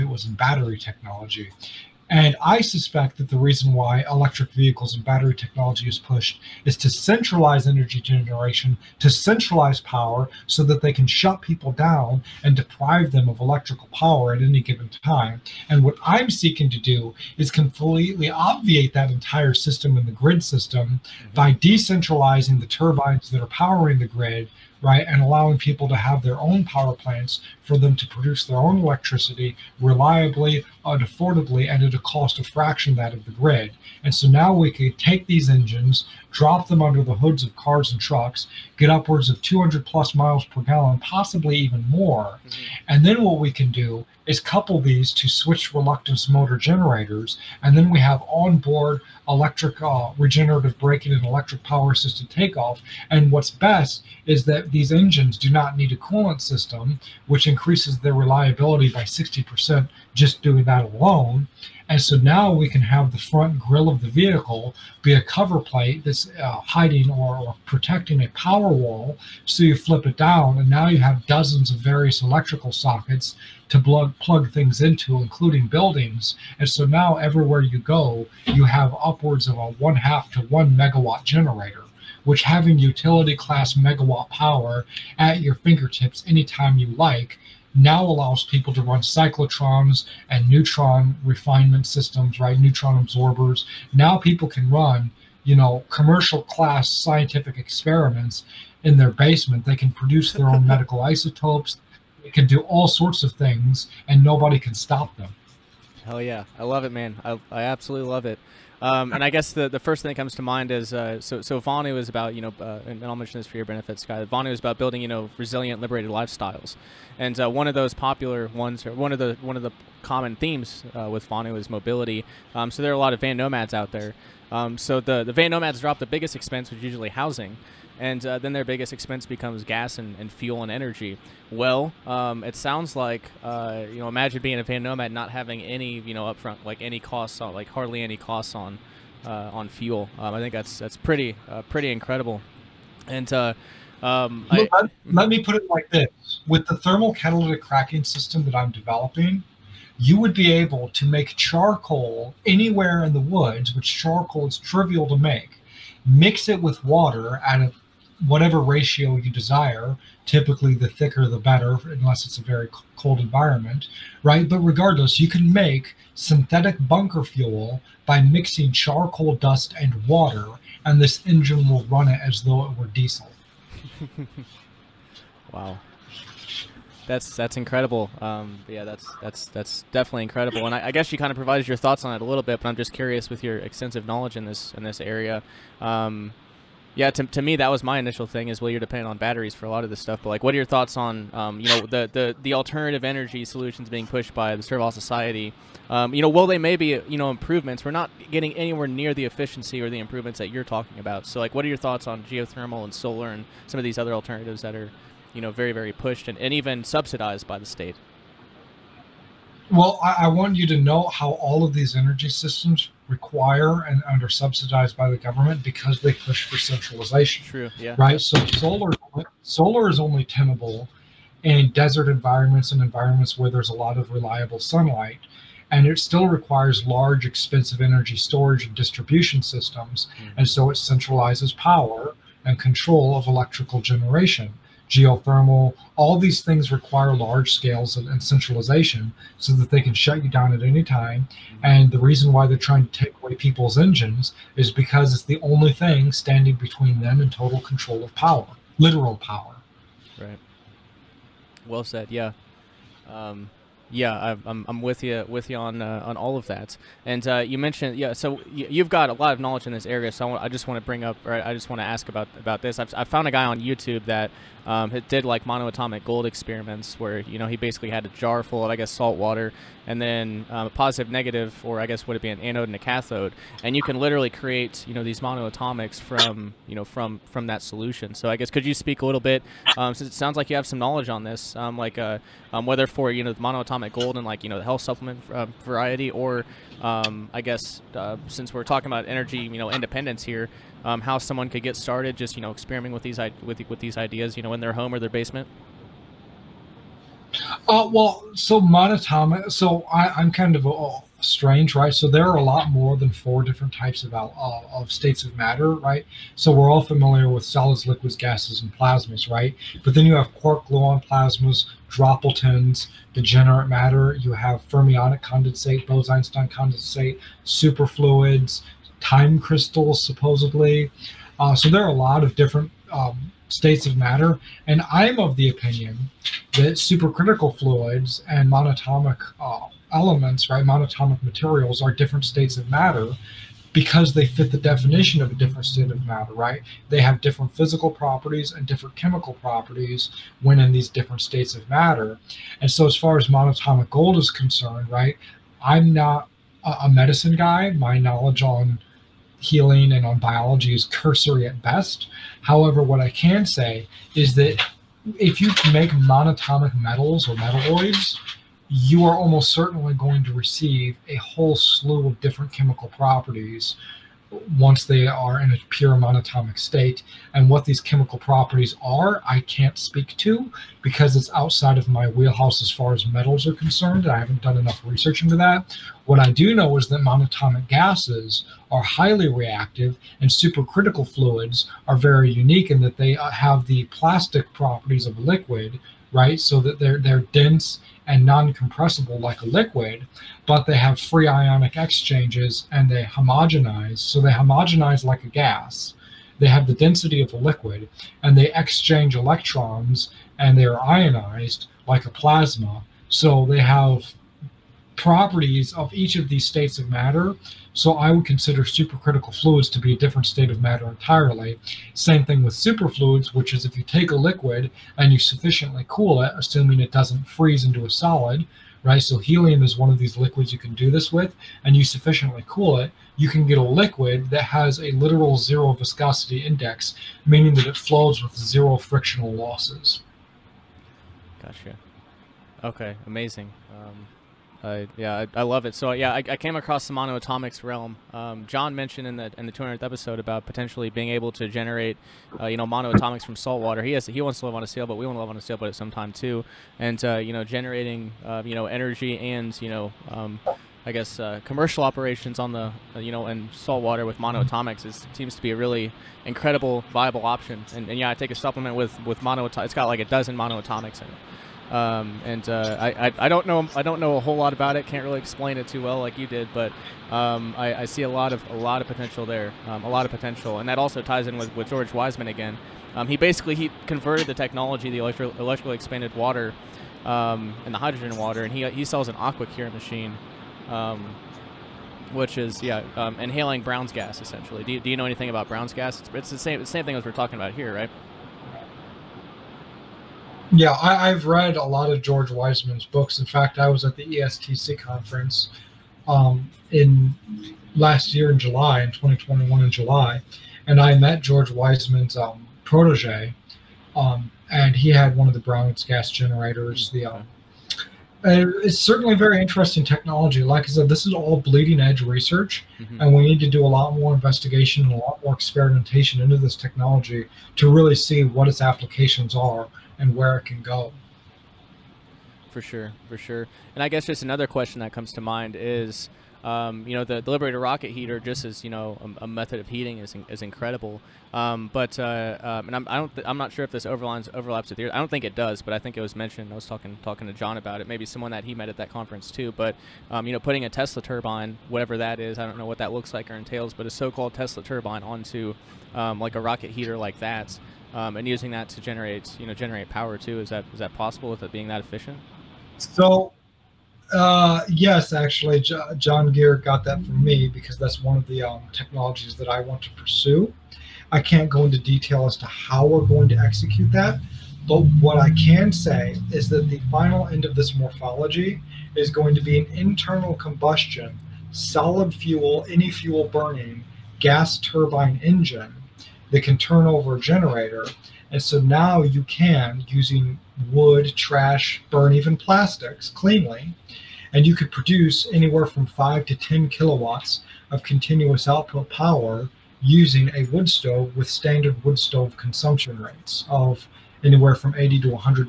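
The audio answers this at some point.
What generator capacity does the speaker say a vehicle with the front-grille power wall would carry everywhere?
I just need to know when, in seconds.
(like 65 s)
79 s.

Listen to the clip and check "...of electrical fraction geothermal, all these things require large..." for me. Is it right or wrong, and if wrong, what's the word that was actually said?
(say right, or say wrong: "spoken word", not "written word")
wrong: "generation", not "fraction".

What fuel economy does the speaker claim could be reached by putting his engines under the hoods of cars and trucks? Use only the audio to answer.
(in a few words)
200 plus miles per gallon.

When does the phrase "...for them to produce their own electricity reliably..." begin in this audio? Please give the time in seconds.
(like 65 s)
27 s.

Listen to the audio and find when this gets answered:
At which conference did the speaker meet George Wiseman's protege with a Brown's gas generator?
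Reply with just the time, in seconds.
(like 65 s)
494 s.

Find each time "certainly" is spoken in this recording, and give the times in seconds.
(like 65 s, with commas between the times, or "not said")
359 s, 508 s.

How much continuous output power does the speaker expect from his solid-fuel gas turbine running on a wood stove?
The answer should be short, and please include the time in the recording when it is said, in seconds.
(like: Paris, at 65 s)
5 to 10 kilowatts, at 585 s.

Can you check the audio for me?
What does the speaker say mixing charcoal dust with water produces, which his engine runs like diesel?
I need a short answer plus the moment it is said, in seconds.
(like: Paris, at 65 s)
synthetic bunker fuel, at 166 s.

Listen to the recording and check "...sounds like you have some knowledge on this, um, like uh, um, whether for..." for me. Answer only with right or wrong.
right.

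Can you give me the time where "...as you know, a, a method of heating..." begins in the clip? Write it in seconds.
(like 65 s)
528 s.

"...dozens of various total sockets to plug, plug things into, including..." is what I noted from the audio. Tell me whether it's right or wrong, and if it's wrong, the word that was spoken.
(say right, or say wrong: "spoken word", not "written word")
wrong: "electrical", not "total".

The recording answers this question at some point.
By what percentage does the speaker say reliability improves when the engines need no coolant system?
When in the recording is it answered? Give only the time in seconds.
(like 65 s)
59 s.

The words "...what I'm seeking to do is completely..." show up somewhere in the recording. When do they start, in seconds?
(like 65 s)
15 s.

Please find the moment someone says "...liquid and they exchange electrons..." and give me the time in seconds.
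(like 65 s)
397 s.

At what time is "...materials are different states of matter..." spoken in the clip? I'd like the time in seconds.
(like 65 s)
331 s.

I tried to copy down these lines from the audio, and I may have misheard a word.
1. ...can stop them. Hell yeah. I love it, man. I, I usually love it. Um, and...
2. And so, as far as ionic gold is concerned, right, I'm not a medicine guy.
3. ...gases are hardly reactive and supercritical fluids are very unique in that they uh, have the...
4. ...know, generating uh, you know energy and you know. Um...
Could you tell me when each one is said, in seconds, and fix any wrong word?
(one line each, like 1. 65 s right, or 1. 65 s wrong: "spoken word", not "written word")
1. 104 s wrong: "absolutely", not "usually"
2. 342 s wrong: "monatomic", not "ionic"
3. 377 s wrong: "highly", not "hardly"
4. 447 s right.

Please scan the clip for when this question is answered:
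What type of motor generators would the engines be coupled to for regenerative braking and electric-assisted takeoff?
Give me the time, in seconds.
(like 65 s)
45 s.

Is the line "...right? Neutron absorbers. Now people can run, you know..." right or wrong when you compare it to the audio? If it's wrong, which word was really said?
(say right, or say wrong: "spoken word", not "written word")
right.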